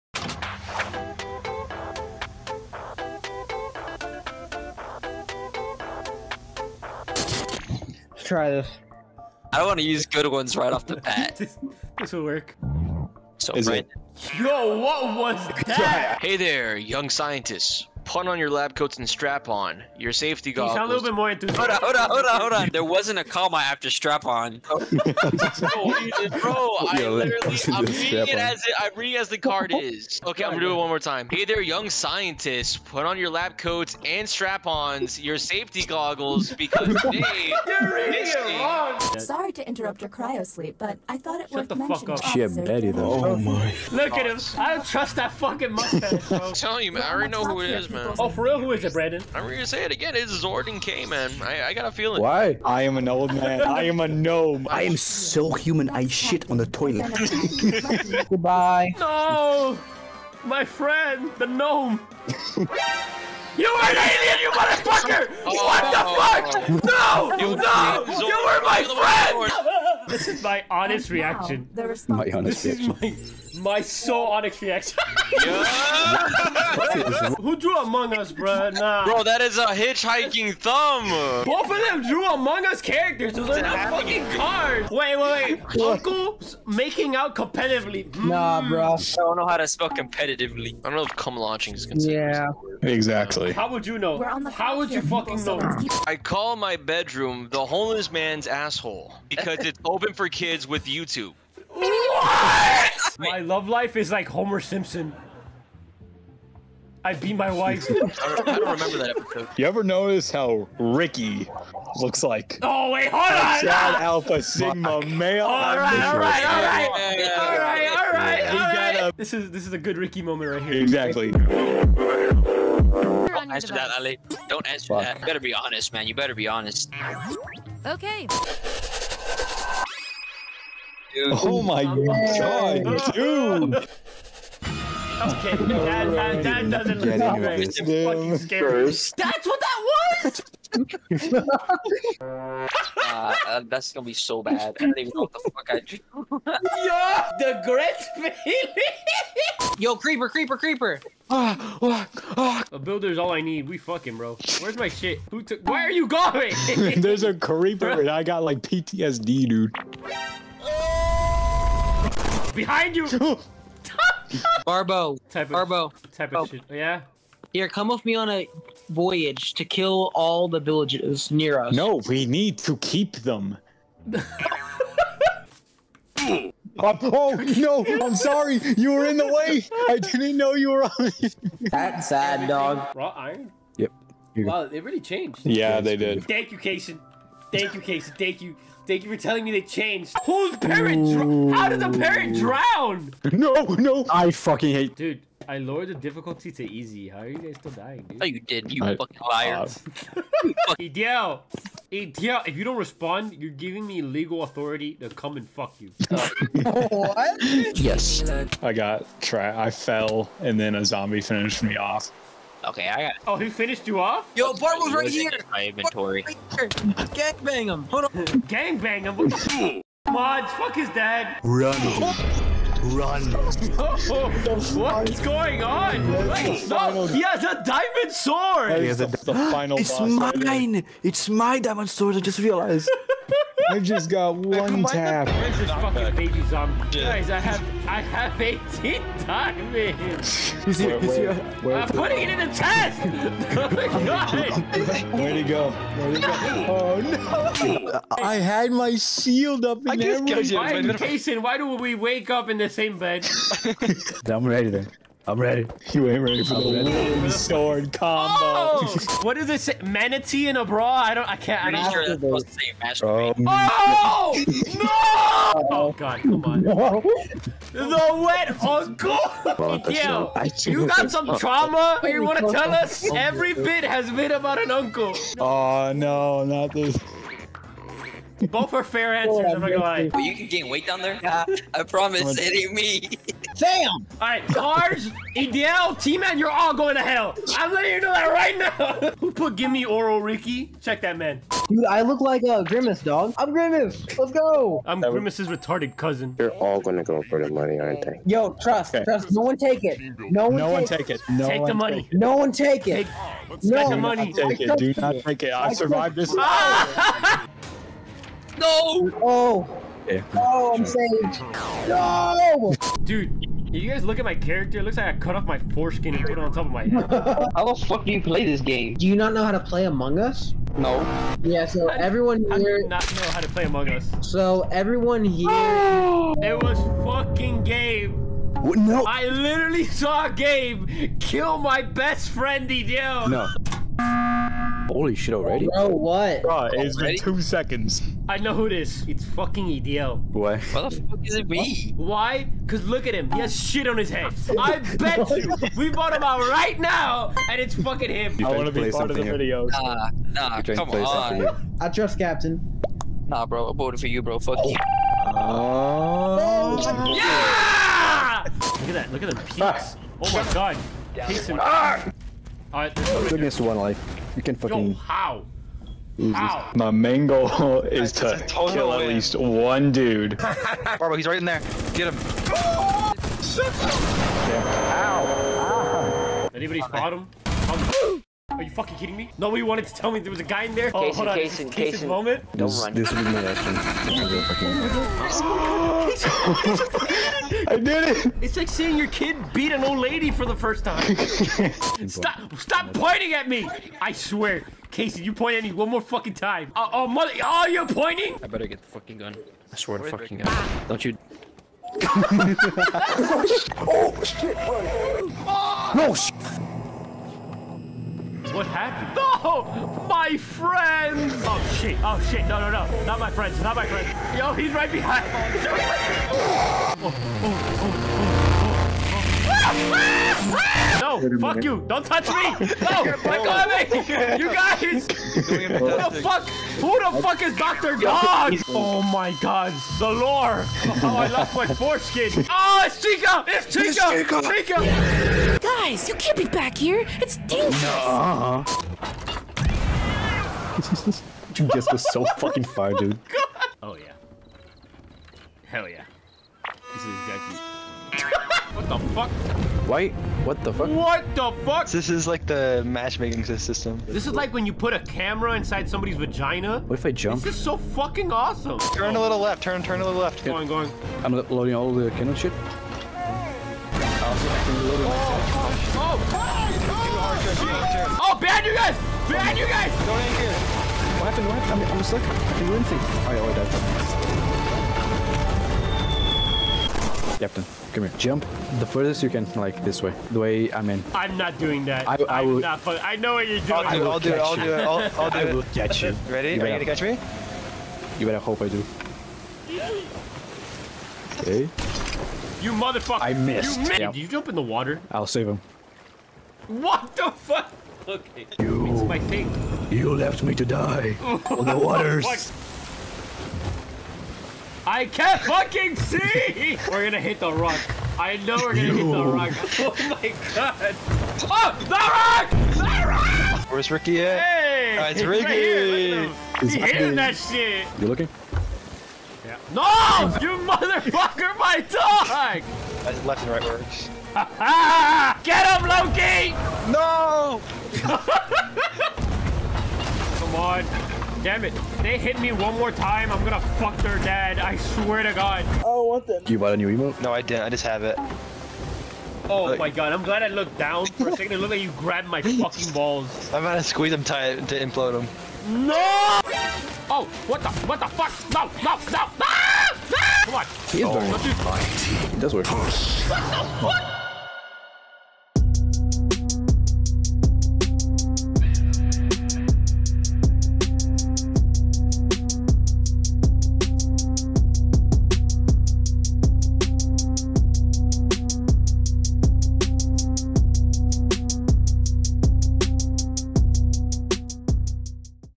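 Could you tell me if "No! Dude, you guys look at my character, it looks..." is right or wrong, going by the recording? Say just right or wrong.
right.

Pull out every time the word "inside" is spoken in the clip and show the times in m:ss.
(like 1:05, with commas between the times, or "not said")
7:35.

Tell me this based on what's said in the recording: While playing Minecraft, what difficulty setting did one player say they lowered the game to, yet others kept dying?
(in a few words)
Easy.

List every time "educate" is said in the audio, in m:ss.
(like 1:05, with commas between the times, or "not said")
not said.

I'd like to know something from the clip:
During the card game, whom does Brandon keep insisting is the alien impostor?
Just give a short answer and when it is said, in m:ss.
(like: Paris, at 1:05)
Zordon K, at 0:50.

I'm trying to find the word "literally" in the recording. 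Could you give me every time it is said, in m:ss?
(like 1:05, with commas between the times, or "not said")
0:27, 5:29.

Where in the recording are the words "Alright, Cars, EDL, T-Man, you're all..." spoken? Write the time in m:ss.
4:44.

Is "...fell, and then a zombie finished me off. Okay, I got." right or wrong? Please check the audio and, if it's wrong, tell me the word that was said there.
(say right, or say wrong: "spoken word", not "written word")
right.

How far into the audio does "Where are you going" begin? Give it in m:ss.
2:35.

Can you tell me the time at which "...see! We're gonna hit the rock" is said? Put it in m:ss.
8:25.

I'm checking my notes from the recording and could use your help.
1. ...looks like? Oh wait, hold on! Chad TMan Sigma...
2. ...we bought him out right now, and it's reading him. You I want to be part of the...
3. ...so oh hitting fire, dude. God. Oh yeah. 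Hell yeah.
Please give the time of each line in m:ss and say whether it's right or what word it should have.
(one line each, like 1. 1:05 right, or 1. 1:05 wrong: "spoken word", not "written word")
1. 1:51 wrong: "Alpha", not "TMan"
2. 5:45 wrong: "fucking", not "reading"
3. 7:22 wrong: "fucking", not "hitting".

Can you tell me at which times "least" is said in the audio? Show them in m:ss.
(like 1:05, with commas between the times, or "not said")
6:09.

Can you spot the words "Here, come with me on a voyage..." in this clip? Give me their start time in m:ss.
2:47.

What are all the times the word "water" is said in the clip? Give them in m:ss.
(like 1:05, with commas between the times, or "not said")
8:14, 8:21.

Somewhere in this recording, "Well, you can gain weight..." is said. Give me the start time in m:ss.
4:40.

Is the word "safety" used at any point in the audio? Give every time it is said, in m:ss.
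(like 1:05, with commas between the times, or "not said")
0:20, 0:35.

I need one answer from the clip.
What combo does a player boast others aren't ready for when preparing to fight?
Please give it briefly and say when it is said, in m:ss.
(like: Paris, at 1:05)
Wind sword combo, at 4:16.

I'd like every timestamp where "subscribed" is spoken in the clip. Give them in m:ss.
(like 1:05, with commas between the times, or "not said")
not said.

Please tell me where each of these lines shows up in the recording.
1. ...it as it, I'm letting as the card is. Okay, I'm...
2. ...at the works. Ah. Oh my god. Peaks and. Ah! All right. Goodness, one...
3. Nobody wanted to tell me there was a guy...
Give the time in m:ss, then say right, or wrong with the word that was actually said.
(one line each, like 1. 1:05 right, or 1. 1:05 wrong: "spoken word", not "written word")
1. 0:28 wrong: "reading", not "letting"
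2. 5:59 wrong: "peaks", not "works"
3. 6:19 right.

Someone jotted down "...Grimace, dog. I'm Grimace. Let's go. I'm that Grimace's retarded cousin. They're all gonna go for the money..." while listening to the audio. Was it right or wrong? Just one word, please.
right.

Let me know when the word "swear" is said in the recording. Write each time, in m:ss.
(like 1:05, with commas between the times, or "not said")
6:34, 6:39, 8:54.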